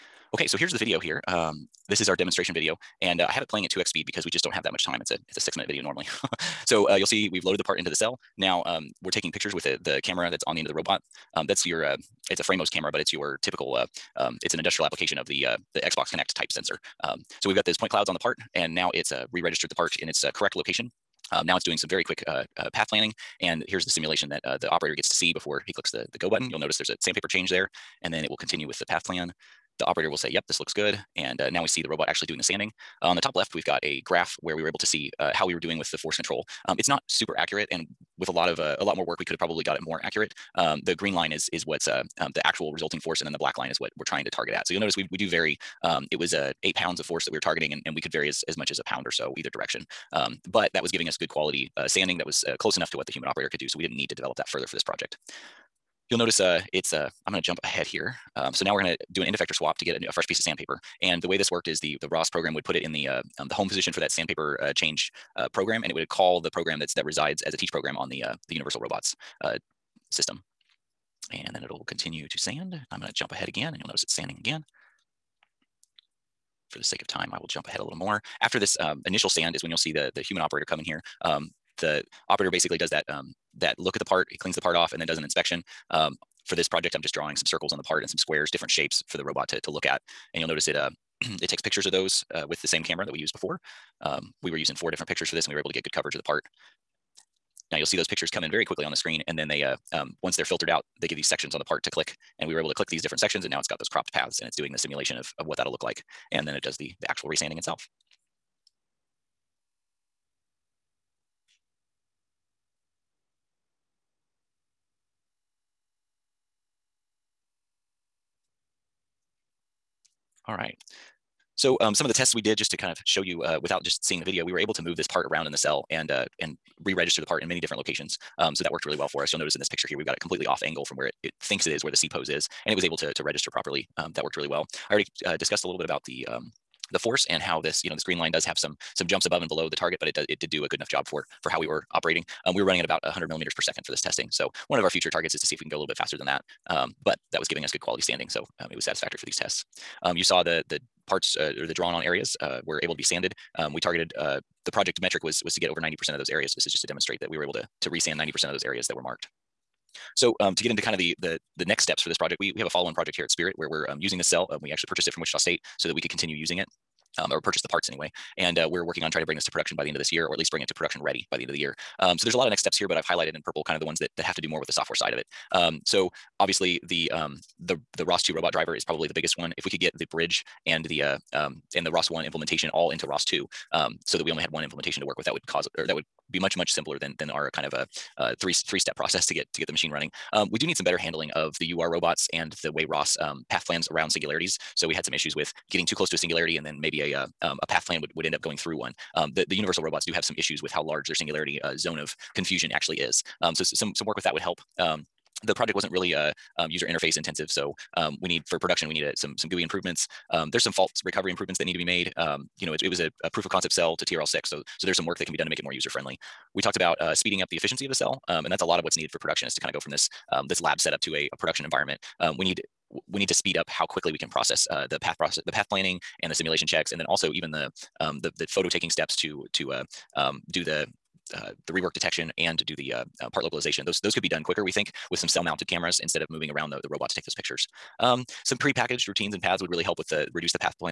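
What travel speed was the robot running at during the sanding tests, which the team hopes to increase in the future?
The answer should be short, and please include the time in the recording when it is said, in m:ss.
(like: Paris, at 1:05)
100 millimeters per second, at 2:23.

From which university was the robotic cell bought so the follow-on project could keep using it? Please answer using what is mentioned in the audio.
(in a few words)
Wichita State.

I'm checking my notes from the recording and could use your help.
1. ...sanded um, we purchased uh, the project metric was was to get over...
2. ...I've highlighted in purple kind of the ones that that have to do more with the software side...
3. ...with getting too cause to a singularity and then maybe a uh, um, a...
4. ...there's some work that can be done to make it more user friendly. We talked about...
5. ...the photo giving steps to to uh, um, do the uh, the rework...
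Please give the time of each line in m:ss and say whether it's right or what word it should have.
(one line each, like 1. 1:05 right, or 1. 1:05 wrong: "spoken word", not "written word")
1. 2:33 wrong: "targeted", not "purchased"
2. 2:52 right
3. 3:15 wrong: "close", not "cause"
4. 3:34 right
5. 3:48 wrong: "taking", not "giving".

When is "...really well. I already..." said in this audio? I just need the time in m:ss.
2:14.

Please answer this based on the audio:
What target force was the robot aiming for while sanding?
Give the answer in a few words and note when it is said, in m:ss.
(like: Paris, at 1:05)
8 pounds, at 0:46.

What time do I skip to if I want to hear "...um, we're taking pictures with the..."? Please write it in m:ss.
0:08.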